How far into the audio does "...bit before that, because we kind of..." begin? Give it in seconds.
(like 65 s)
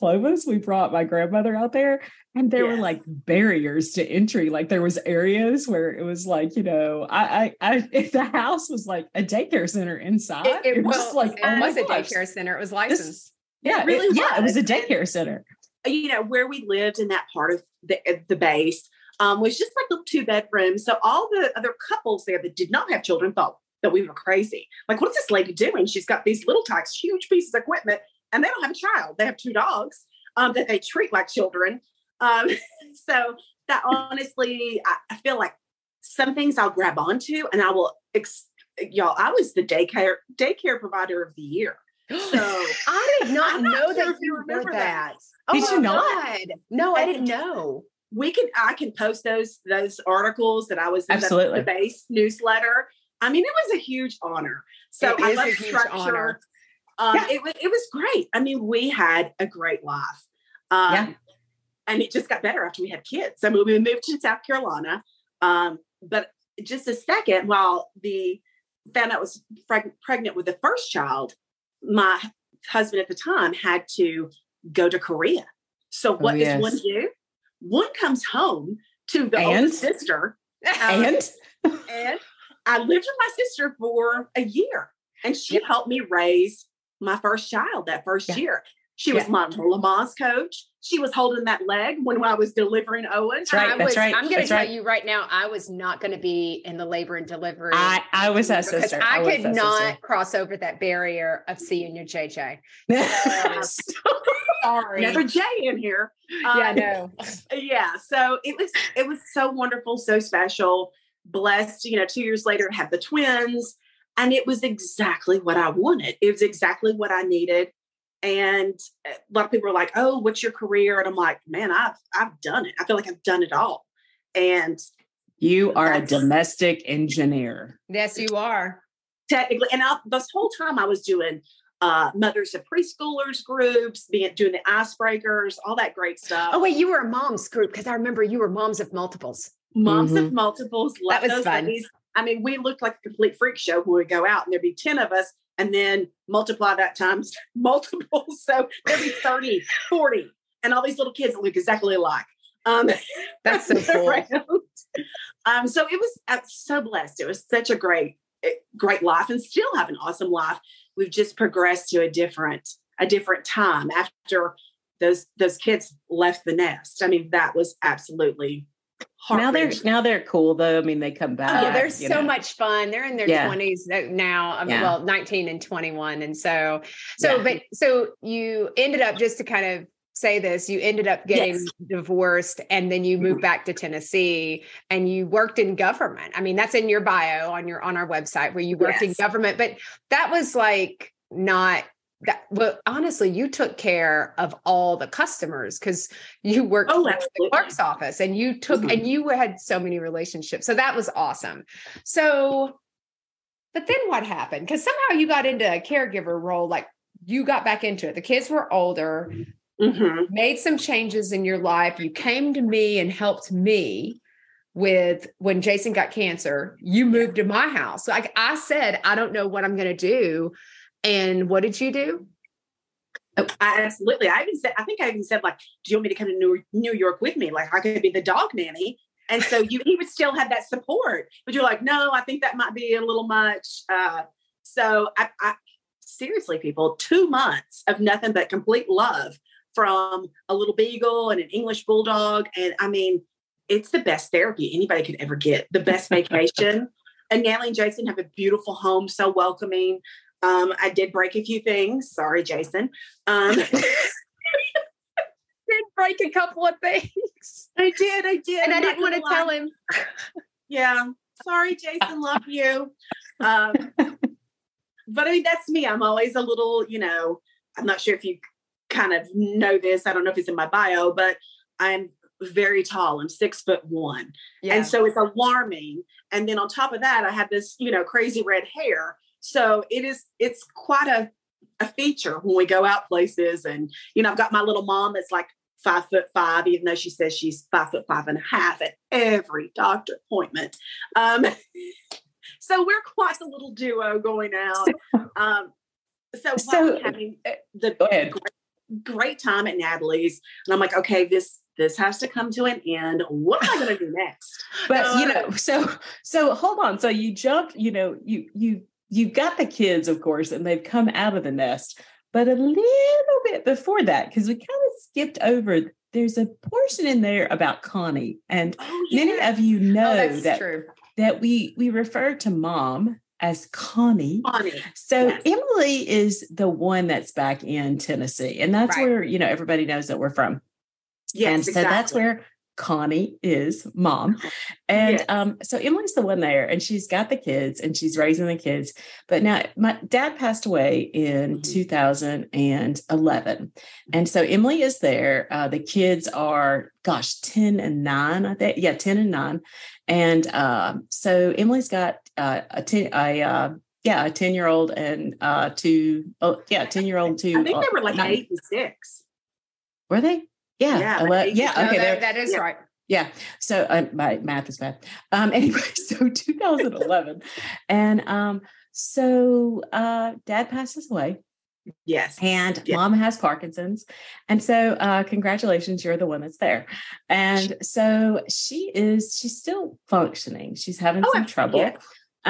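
313 s.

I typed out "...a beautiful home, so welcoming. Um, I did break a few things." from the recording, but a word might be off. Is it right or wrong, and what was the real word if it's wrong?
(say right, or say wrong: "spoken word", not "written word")
right.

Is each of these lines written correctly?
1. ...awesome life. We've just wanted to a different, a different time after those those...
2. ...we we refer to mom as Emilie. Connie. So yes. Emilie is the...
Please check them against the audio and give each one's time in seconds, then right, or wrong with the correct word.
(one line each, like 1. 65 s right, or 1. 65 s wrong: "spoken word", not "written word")
1. 160 s wrong: "progressed", not "wanted"
2. 321 s wrong: "Connie", not "Emilie".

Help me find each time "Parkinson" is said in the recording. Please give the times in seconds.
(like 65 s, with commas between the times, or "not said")
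373 s.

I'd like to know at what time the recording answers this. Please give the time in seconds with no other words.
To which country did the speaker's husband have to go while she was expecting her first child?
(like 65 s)
74 s.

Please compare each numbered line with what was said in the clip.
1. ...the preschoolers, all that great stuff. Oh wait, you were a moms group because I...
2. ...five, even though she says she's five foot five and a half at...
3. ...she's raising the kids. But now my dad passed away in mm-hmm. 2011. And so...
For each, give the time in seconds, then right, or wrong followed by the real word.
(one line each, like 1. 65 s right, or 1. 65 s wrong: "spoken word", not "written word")
1. 134 s wrong: "icebreakers", not "preschoolers"
2. 286 s right
3. 337 s right.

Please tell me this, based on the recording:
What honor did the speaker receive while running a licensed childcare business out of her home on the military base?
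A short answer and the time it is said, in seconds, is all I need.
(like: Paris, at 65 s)
Daycare provider of the year, at 40 s.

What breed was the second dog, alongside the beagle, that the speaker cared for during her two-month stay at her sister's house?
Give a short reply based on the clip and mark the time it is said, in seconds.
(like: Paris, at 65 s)
English bulldog, at 241 s.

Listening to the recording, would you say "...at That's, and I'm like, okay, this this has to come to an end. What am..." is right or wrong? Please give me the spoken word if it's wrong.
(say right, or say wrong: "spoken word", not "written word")
wrong: "Natalie", not "That".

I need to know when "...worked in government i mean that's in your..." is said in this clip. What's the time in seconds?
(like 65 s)
185 s.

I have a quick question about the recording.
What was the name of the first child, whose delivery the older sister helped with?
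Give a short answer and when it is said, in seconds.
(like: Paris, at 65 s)
Owen, at 93 s.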